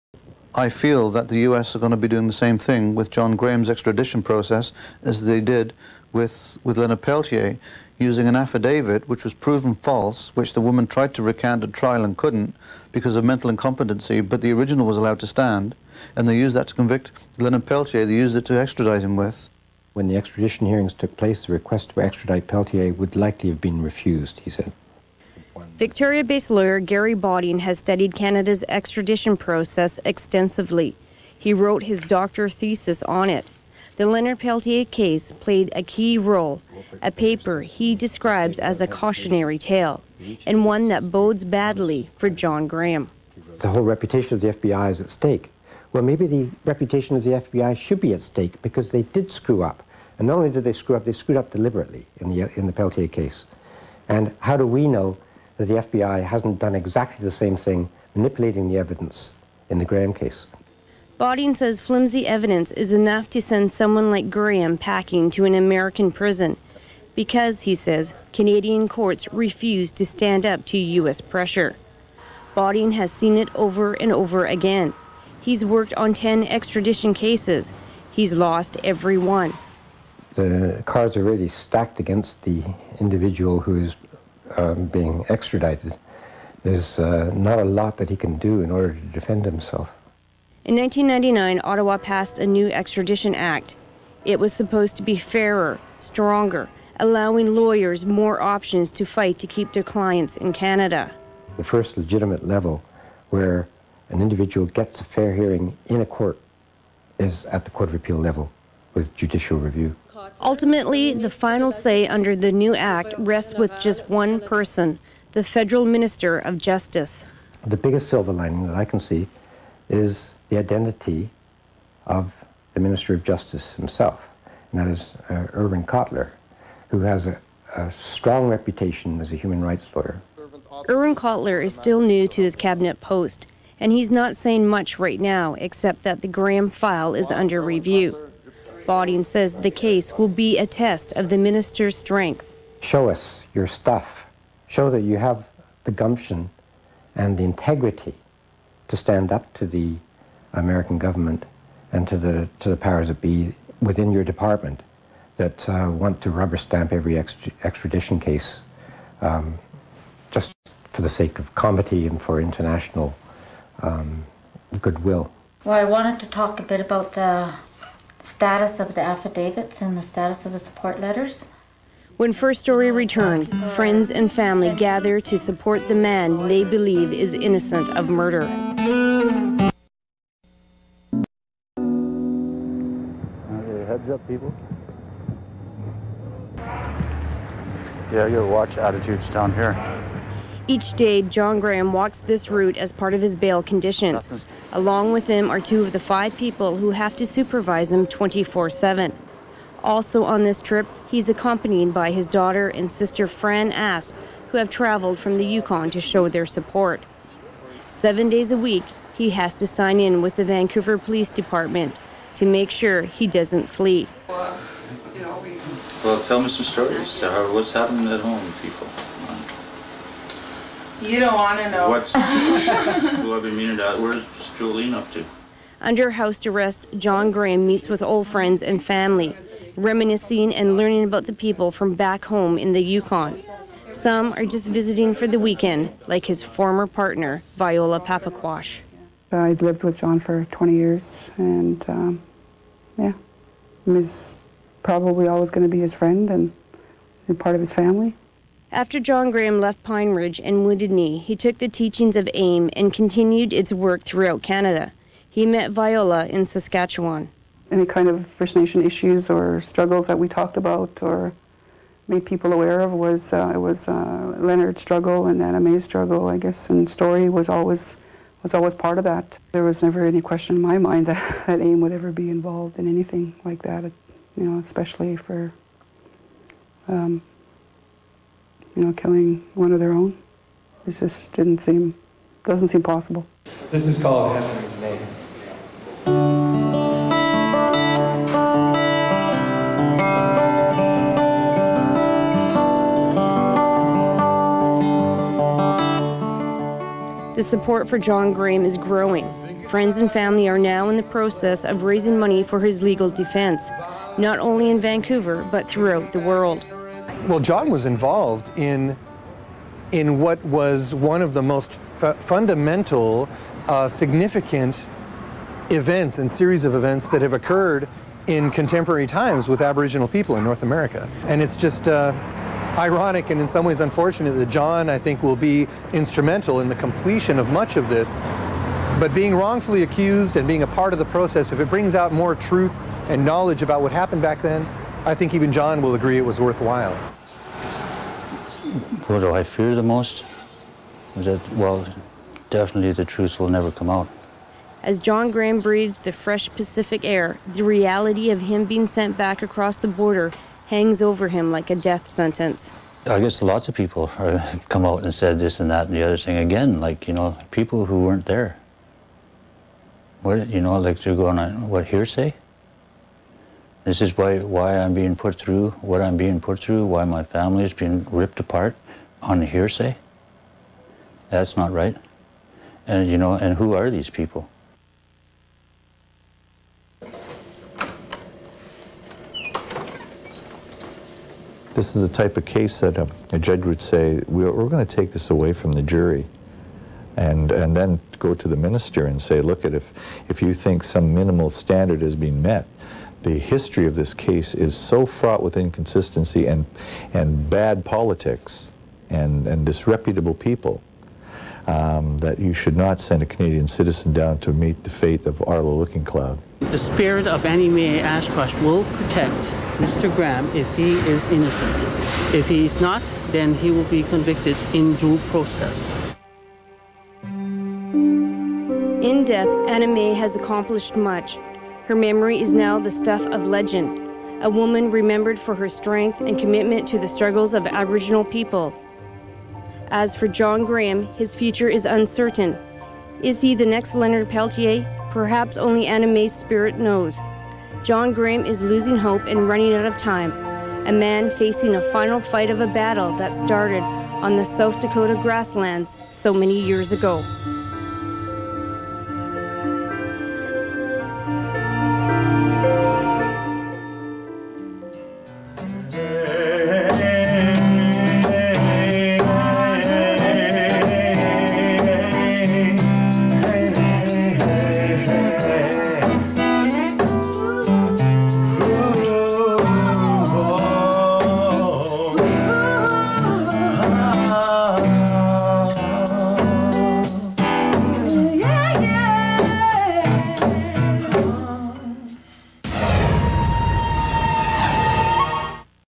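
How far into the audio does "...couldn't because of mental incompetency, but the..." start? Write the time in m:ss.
0:12.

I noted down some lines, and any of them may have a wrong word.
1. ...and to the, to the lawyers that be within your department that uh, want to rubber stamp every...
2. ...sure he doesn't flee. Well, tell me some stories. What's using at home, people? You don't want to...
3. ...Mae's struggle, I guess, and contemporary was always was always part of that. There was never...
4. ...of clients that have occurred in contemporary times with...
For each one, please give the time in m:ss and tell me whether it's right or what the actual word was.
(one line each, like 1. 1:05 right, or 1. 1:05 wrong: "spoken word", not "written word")
1. 2:31 wrong: "powers", not "lawyers"
2. 3:32 wrong: "happening", not "using"
3. 4:25 wrong: "story", not "contemporary"
4. 5:16 wrong: "events", not "clients".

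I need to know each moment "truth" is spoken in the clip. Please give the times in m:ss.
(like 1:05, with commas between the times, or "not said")
5:32, 5:43.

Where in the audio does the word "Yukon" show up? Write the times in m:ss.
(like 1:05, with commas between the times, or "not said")
3:25, 3:52.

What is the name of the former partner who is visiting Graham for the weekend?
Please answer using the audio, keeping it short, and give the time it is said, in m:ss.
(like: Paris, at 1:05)
Viola Papaquash, at 3:57.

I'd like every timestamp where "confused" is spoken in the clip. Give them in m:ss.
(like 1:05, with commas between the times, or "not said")
not said.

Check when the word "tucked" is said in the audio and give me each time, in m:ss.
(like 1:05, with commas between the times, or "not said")
not said.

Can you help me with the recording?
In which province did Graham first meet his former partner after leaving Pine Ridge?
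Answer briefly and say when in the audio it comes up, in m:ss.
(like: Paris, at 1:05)
Saskatchewan, at 4:16.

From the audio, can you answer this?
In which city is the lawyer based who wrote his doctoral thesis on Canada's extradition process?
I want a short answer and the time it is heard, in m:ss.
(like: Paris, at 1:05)
Victoria, at 0:25.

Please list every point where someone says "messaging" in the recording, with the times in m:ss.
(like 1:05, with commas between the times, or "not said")
not said.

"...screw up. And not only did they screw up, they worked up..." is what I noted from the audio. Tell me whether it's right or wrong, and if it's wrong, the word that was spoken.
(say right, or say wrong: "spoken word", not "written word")
wrong: "screwed", not "worked".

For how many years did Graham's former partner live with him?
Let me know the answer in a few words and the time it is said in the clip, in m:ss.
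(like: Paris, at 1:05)
20, at 4:00.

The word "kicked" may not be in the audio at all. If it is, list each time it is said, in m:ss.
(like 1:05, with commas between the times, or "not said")
not said.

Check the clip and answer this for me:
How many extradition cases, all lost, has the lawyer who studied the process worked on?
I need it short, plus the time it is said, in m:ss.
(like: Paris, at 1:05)
10, at 1:16.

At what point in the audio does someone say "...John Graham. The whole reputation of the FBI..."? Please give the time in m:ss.
0:42.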